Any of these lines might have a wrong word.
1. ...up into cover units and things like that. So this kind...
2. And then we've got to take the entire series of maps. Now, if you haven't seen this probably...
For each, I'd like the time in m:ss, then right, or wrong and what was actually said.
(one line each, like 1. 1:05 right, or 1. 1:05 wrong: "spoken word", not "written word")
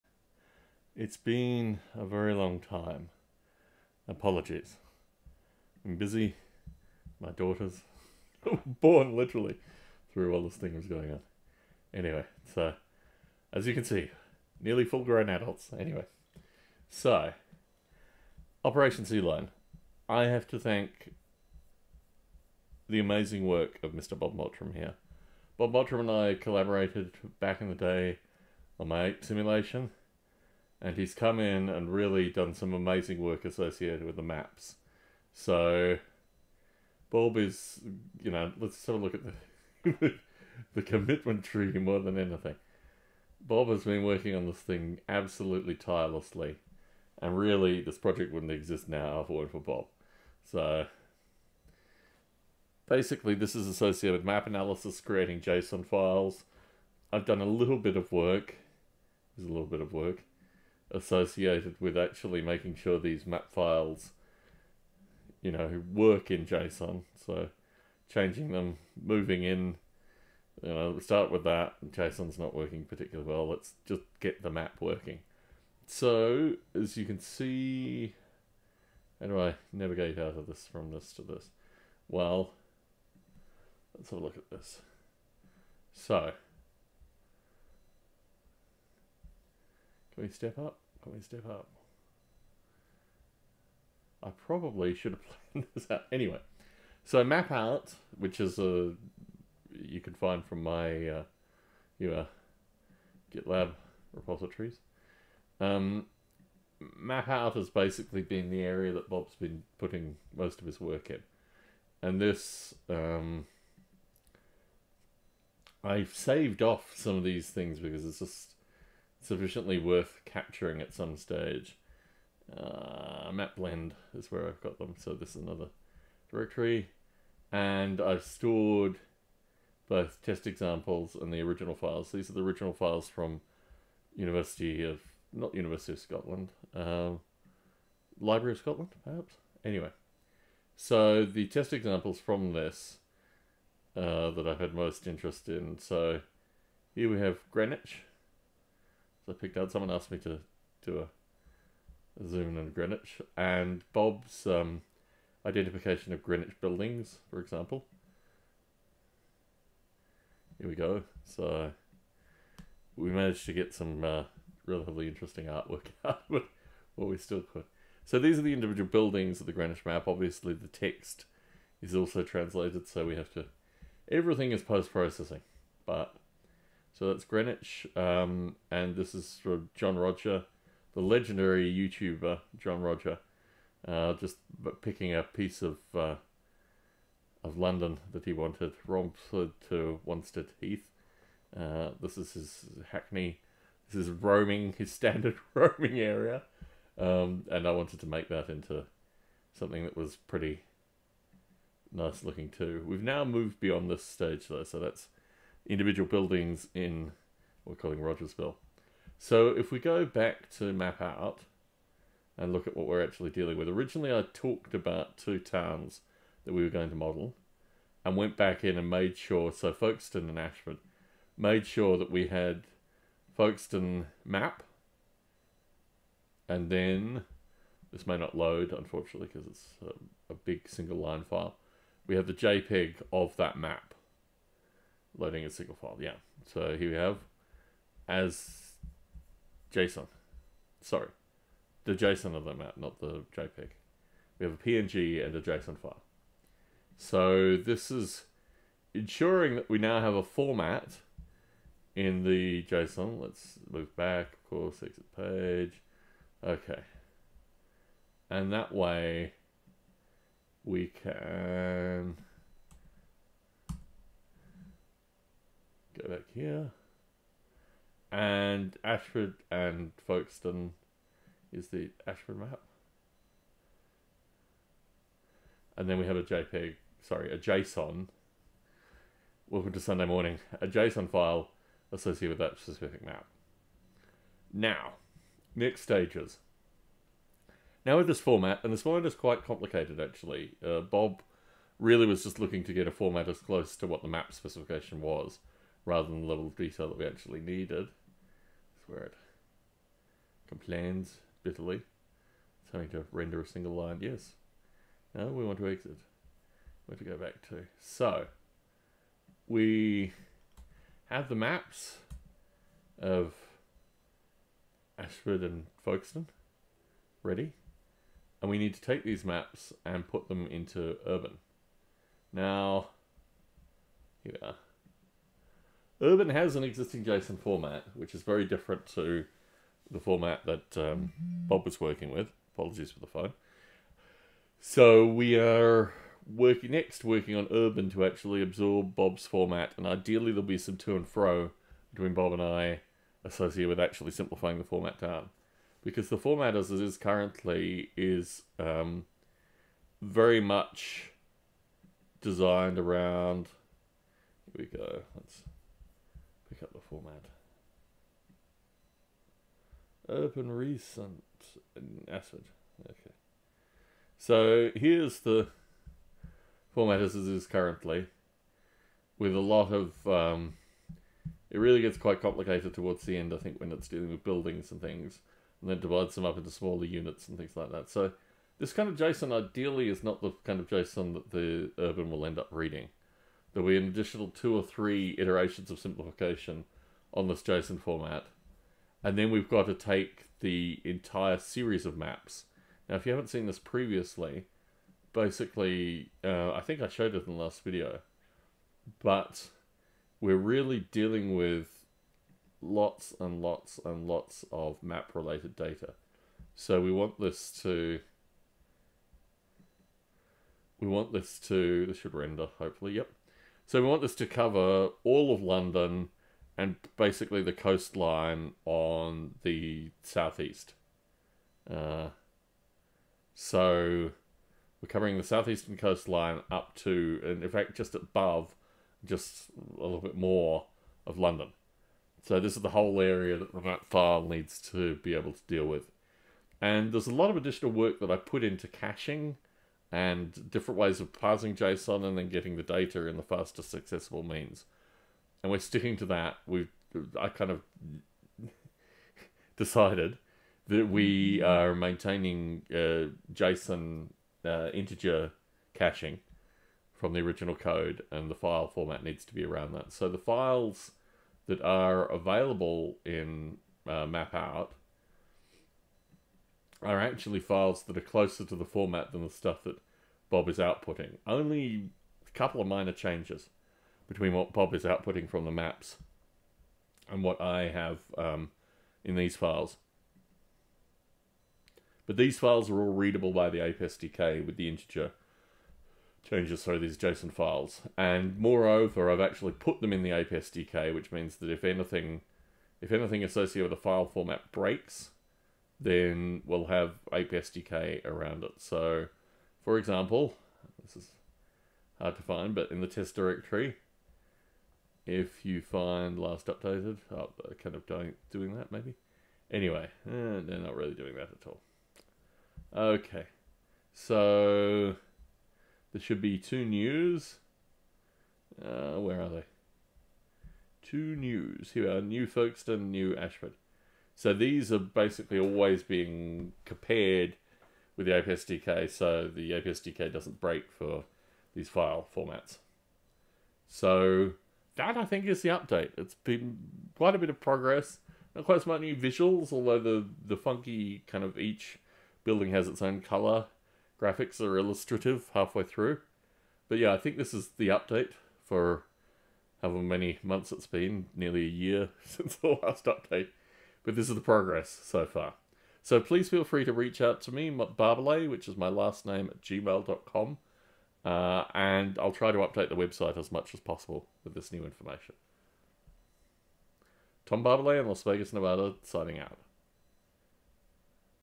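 1. 6:16 wrong: "smaller", not "cover"
2. 6:29 wrong: "previously", not "probably".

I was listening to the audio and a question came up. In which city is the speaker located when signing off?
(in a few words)
Las Vegas.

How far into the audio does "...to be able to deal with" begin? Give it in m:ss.
7:14.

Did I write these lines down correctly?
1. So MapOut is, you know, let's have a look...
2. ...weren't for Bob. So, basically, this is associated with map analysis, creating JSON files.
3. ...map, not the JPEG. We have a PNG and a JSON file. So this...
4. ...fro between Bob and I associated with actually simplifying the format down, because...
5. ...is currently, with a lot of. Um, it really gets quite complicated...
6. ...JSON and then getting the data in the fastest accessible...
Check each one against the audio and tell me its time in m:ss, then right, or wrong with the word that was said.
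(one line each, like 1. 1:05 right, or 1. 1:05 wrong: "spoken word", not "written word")
1. 0:35 wrong: "Bob", not "MapOut"
2. 0:49 right
3. 4:02 right
4. 5:41 right
5. 6:07 right
6. 7:21 right.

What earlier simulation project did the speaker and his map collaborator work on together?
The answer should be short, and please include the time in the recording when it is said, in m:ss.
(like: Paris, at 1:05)
ape simulation, at 0:29.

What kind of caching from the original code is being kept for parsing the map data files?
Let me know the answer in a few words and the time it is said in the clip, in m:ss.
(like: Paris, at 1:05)
integer caching, at 7:34.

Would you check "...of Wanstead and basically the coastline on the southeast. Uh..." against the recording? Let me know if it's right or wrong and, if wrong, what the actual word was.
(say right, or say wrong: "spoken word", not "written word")
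wrong: "London", not "Wanstead".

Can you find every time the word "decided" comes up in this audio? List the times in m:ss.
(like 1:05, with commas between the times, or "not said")
7:29.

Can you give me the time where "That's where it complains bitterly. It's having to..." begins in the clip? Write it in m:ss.
4:58.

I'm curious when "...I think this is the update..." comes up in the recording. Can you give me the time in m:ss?
9:06.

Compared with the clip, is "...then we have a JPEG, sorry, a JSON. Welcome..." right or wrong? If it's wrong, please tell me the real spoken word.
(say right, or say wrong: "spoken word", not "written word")
right.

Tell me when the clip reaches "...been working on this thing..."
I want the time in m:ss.
0:43.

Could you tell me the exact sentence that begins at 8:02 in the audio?
But these files are all readable by the APE SDK with the integer changes, so these JSON files.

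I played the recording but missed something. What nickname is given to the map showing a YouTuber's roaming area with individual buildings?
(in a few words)
Rogersville.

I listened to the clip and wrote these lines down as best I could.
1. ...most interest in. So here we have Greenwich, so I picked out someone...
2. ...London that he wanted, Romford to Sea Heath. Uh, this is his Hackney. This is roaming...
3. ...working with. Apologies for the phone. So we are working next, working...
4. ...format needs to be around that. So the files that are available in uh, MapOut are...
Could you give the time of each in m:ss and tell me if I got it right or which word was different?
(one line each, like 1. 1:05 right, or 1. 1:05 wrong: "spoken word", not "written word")
1. 2:24 right
2. 3:07 wrong: "Wanstead", not "Sea"
3. 5:31 right
4. 7:38 right.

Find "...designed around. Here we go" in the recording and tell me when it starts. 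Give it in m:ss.
5:52.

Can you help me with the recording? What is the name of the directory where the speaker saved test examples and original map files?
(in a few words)
mapblend.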